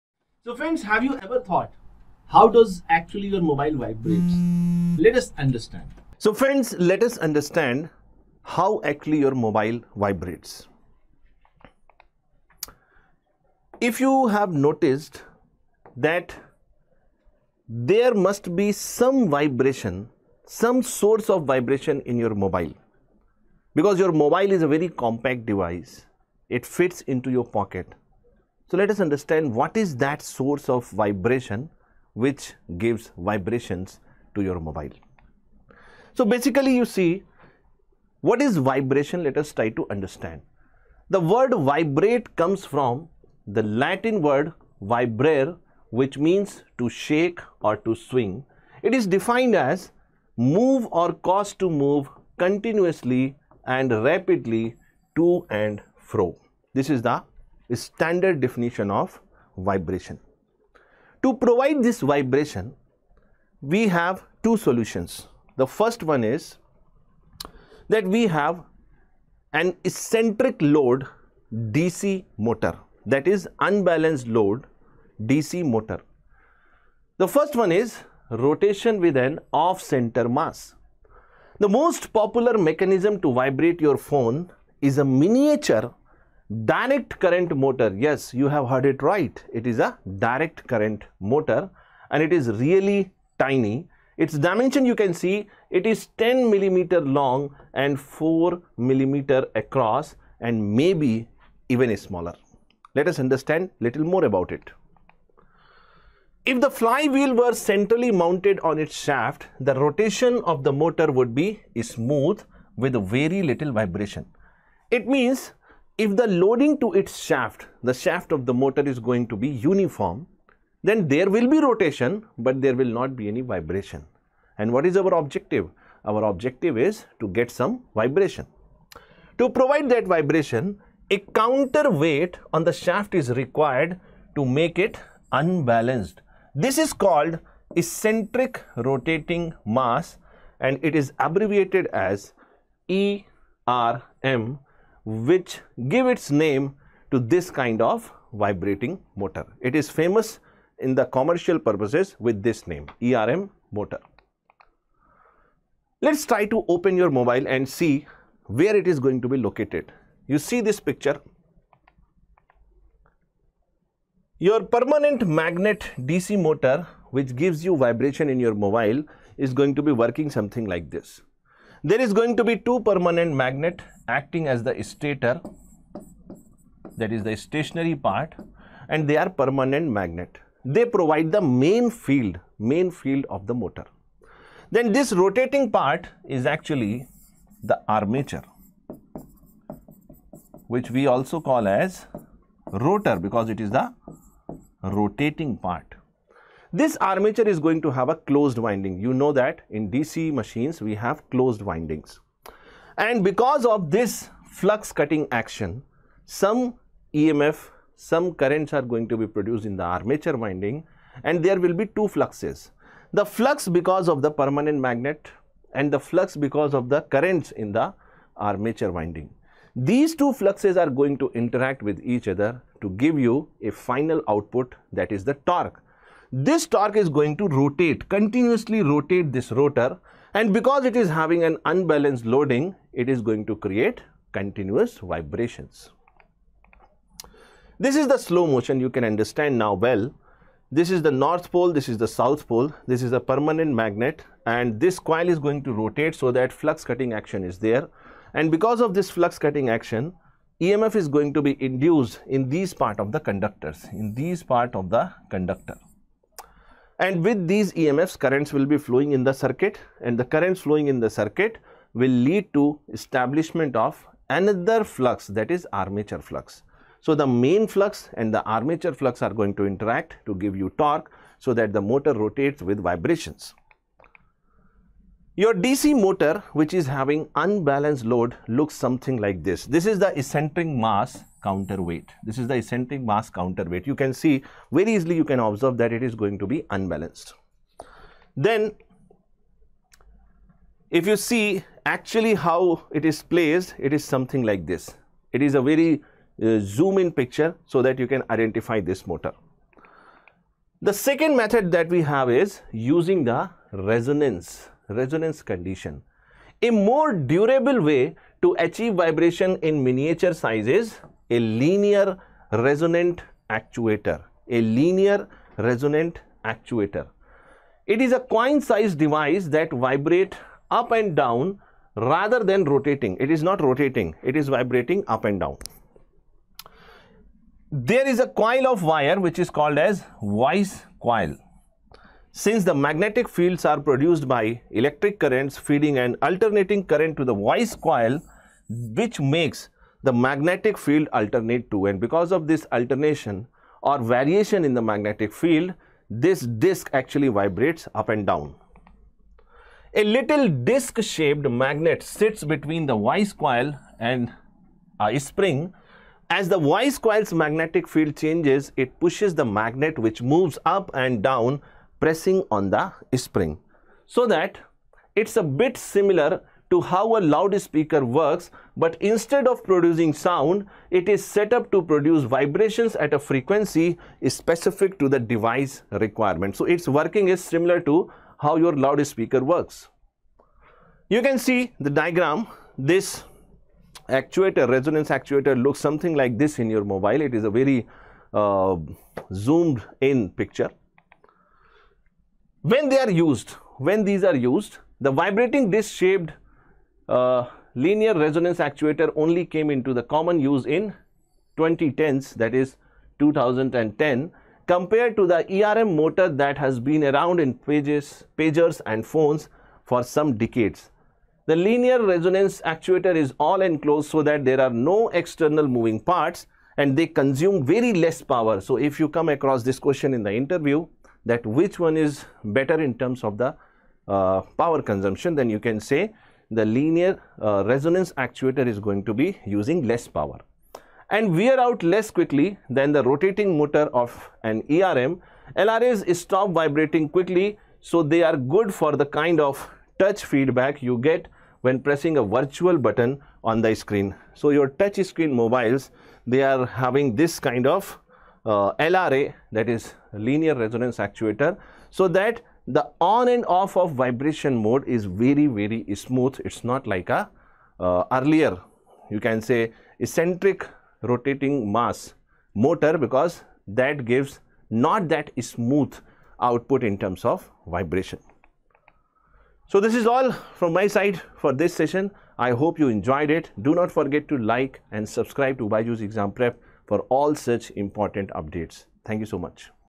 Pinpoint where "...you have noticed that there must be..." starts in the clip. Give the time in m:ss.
0:14.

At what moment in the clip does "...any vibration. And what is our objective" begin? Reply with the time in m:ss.
2:03.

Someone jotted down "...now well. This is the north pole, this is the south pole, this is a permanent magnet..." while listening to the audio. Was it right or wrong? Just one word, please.
right.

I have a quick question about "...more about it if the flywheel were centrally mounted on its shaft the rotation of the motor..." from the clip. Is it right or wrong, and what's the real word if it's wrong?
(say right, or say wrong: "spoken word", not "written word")
right.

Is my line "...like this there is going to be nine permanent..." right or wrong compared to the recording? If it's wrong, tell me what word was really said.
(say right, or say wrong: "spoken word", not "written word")
wrong: "two", not "nine".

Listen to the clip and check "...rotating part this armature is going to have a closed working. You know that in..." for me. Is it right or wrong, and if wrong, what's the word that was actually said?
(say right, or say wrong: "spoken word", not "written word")
wrong: "winding", not "working".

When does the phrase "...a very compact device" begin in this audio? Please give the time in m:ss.
0:24.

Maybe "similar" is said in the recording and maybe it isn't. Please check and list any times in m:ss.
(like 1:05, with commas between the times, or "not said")
6:05, 6:17.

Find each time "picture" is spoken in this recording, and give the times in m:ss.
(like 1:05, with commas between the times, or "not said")
2:40, 4:57, 6:30.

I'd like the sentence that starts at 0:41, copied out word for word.
The word vibrate comes from the Latin word vibrare which means to shake or to swing.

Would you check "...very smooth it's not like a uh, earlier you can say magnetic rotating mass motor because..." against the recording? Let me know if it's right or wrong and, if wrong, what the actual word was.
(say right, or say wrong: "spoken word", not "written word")
wrong: "eccentric", not "magnetic".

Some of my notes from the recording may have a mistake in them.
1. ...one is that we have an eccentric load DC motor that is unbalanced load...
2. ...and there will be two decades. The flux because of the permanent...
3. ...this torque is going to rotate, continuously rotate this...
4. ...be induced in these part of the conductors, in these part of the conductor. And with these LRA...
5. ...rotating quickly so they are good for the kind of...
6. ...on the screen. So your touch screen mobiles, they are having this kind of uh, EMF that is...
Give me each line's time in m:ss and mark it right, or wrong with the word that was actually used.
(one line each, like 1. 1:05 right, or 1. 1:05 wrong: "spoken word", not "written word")
1. 1:06 right
2. 3:31 wrong: "fluxes", not "decades"
3. 3:46 right
4. 4:11 wrong: "EMFs", not "LRA"
5. 7:16 wrong: "vibrating", not "rotating"
6. 7:23 wrong: "LRA", not "EMF".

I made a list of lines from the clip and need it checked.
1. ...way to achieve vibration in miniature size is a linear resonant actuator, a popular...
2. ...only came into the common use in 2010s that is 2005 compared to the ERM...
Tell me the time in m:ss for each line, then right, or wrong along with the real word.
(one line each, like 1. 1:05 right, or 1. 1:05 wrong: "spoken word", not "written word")
1. 5:07 wrong: "linear", not "popular"
2. 6:39 wrong: "2010", not "2005".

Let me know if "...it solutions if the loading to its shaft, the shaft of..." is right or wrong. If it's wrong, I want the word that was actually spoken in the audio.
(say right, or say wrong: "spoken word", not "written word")
wrong: "means", not "solutions".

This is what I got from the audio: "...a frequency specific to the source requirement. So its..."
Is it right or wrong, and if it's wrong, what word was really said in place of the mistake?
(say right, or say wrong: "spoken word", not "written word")
wrong: "device", not "source".